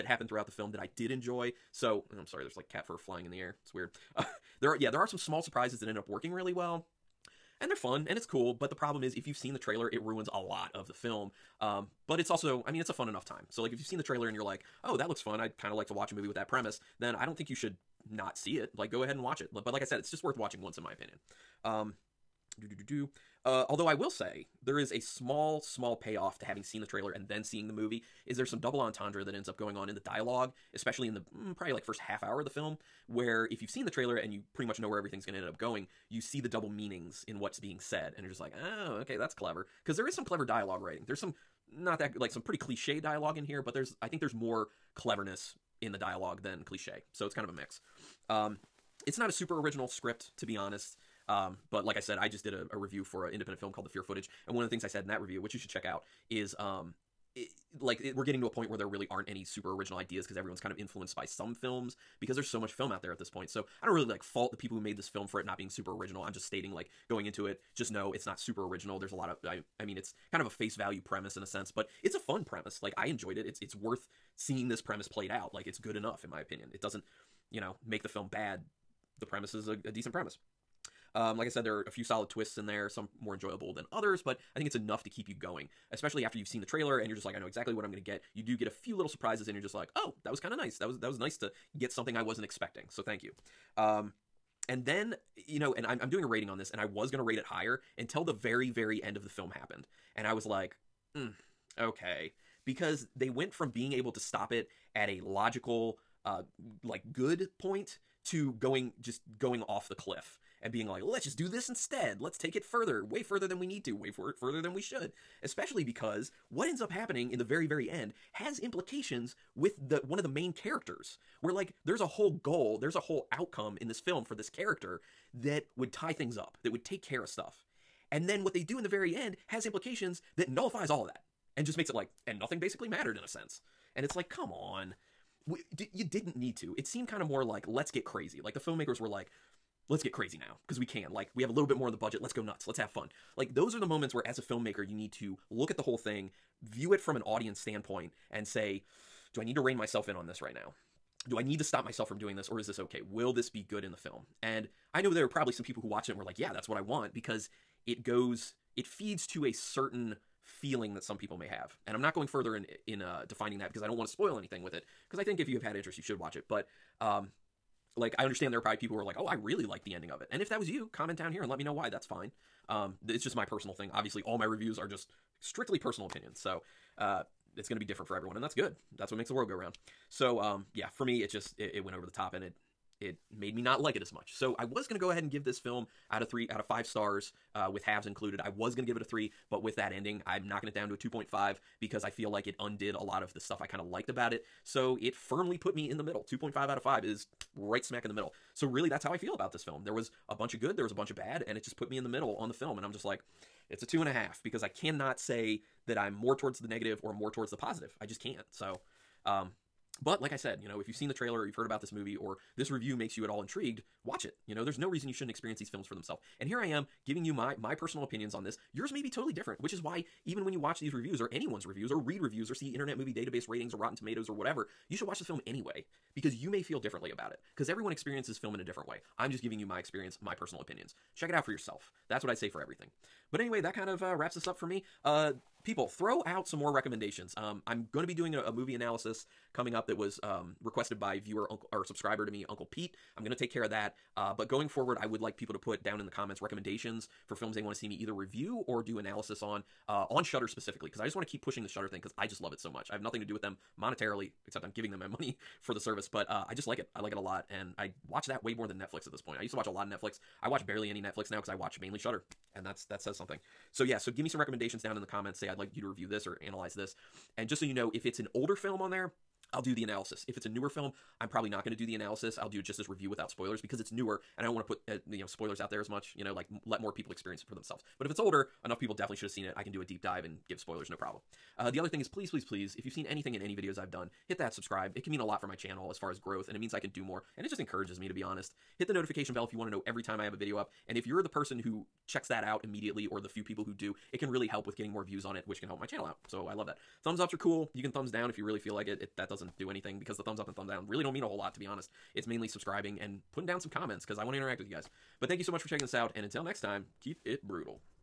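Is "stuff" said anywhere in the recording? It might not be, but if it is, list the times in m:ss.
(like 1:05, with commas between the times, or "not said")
2:07, 3:13.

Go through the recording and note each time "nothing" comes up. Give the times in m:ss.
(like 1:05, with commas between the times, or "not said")
2:12, 4:13.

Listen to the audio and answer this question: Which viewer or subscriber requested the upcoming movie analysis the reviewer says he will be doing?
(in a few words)
Uncle Pete.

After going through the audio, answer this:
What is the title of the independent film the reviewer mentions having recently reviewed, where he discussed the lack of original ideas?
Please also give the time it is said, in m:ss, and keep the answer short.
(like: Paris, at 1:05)
The Fear Footage, at 0:53.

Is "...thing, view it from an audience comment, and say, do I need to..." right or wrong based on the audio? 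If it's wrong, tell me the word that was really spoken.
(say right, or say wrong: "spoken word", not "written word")
wrong: "standpoint", not "comment".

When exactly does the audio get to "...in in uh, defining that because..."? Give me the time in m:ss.
2:42.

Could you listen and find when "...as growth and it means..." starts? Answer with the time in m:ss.
4:46.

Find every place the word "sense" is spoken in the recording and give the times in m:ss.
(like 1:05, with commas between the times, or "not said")
1:11, 2:13.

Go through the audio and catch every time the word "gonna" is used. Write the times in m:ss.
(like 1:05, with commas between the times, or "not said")
1:37.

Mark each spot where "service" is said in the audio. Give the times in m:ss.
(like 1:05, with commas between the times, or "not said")
4:15.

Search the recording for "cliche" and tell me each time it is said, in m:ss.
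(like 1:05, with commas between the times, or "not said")
0:42, 0:46.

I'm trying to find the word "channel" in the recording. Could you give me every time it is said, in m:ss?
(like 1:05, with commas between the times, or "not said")
4:45, 4:55.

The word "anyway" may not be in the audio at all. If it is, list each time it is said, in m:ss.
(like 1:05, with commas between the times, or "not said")
3:45, 3:53.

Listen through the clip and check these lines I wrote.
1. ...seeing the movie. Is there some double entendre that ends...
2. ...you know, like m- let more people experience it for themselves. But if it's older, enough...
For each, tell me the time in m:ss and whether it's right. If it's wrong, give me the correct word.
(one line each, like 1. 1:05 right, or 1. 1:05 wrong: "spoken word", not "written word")
1. 0:27 right
2. 4:36 right.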